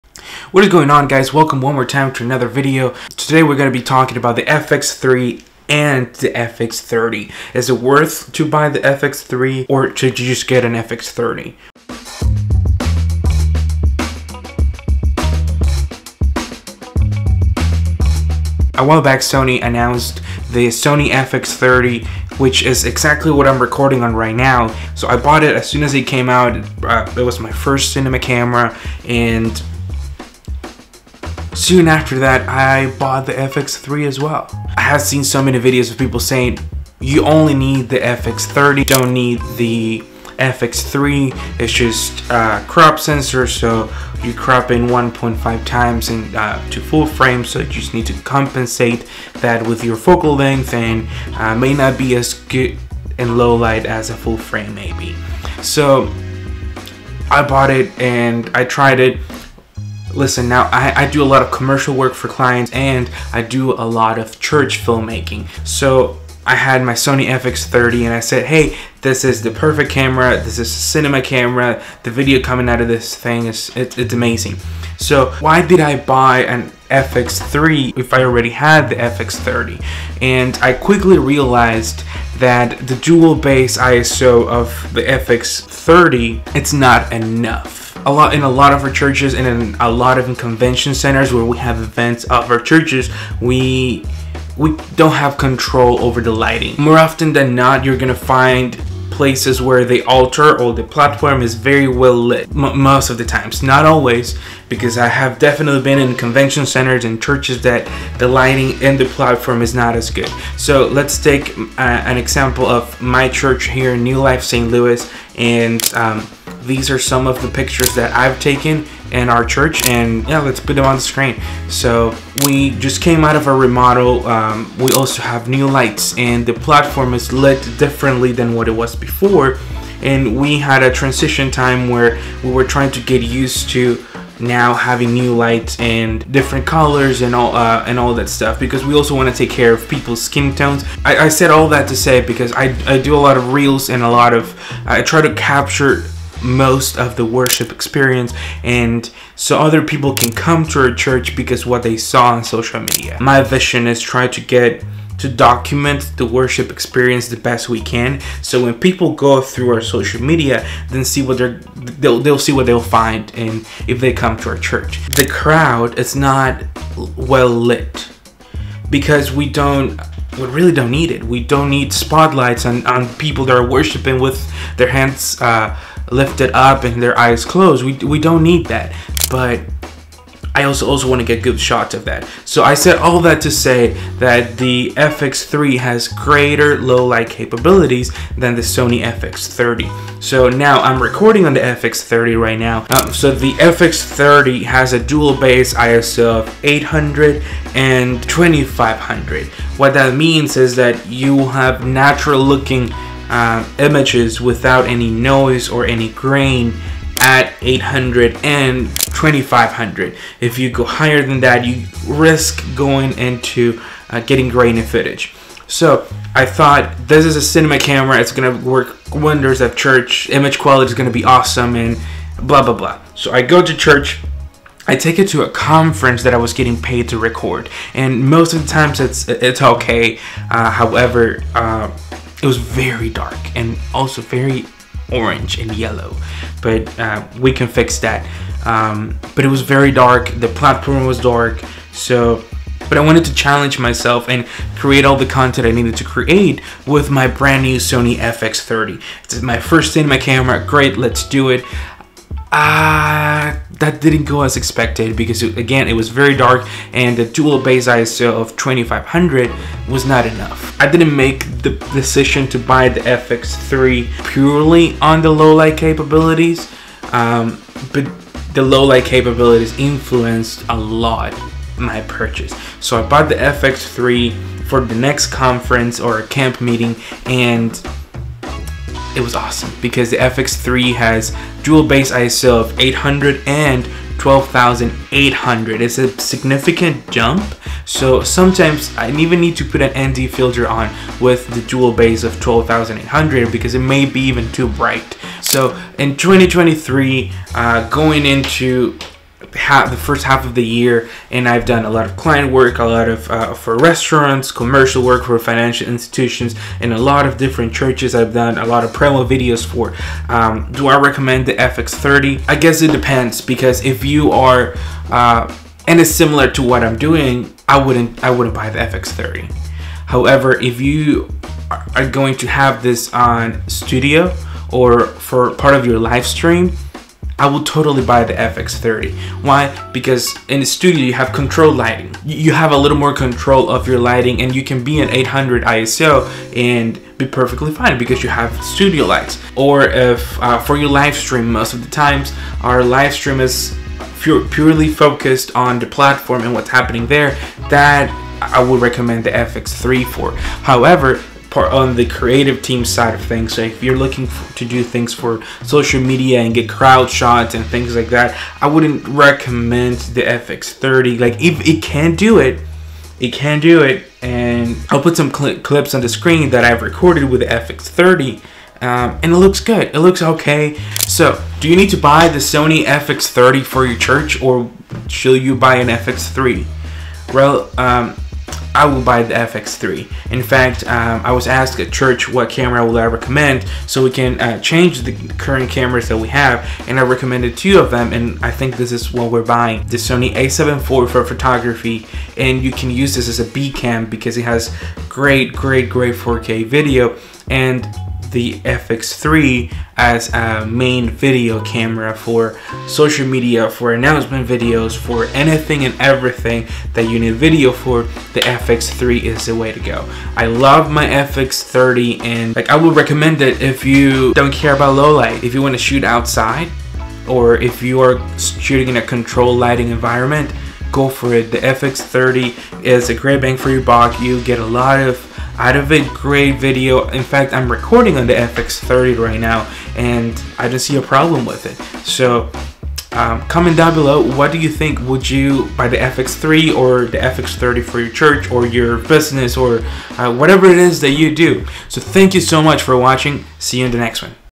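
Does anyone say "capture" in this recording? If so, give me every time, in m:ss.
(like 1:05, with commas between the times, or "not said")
2:25.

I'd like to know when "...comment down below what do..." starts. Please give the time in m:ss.
7:13.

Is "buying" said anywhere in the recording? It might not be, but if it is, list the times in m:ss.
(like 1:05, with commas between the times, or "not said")
6:29.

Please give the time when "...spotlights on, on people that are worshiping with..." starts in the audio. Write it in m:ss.
2:51.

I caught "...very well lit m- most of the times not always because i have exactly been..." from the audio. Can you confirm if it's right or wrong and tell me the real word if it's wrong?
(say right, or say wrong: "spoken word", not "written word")
wrong: "definitely", not "exactly".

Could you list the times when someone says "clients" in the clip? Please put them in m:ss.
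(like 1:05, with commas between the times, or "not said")
1:02, 5:02.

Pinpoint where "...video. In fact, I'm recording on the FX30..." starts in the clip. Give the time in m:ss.
7:06.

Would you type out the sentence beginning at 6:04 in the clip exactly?
And I'll put some cl clips on the screen that I've recorded with the FX30.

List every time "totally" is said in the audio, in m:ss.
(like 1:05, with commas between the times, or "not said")
5:27.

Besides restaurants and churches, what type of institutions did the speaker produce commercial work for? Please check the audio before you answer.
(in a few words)
financial institutions.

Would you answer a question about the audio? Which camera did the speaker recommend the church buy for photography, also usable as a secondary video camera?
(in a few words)
Sony a7 IV.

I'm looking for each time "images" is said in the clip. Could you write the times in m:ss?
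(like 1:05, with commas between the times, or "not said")
3:23, 3:40.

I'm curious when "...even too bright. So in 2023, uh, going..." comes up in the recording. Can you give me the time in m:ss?
4:54.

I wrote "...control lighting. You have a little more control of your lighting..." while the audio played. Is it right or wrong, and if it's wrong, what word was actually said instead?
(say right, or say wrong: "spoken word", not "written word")
right.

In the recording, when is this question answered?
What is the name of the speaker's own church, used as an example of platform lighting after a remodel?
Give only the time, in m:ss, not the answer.
1:53.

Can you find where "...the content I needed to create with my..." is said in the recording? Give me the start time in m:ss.
4:05.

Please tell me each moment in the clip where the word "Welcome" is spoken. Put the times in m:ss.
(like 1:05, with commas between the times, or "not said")
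0:01.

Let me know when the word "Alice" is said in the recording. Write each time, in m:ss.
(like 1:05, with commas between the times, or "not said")
not said.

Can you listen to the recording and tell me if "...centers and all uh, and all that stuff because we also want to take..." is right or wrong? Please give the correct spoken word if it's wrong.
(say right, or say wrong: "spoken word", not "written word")
wrong: "colors", not "centers".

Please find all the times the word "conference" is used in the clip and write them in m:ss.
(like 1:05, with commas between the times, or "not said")
3:45, 4:35.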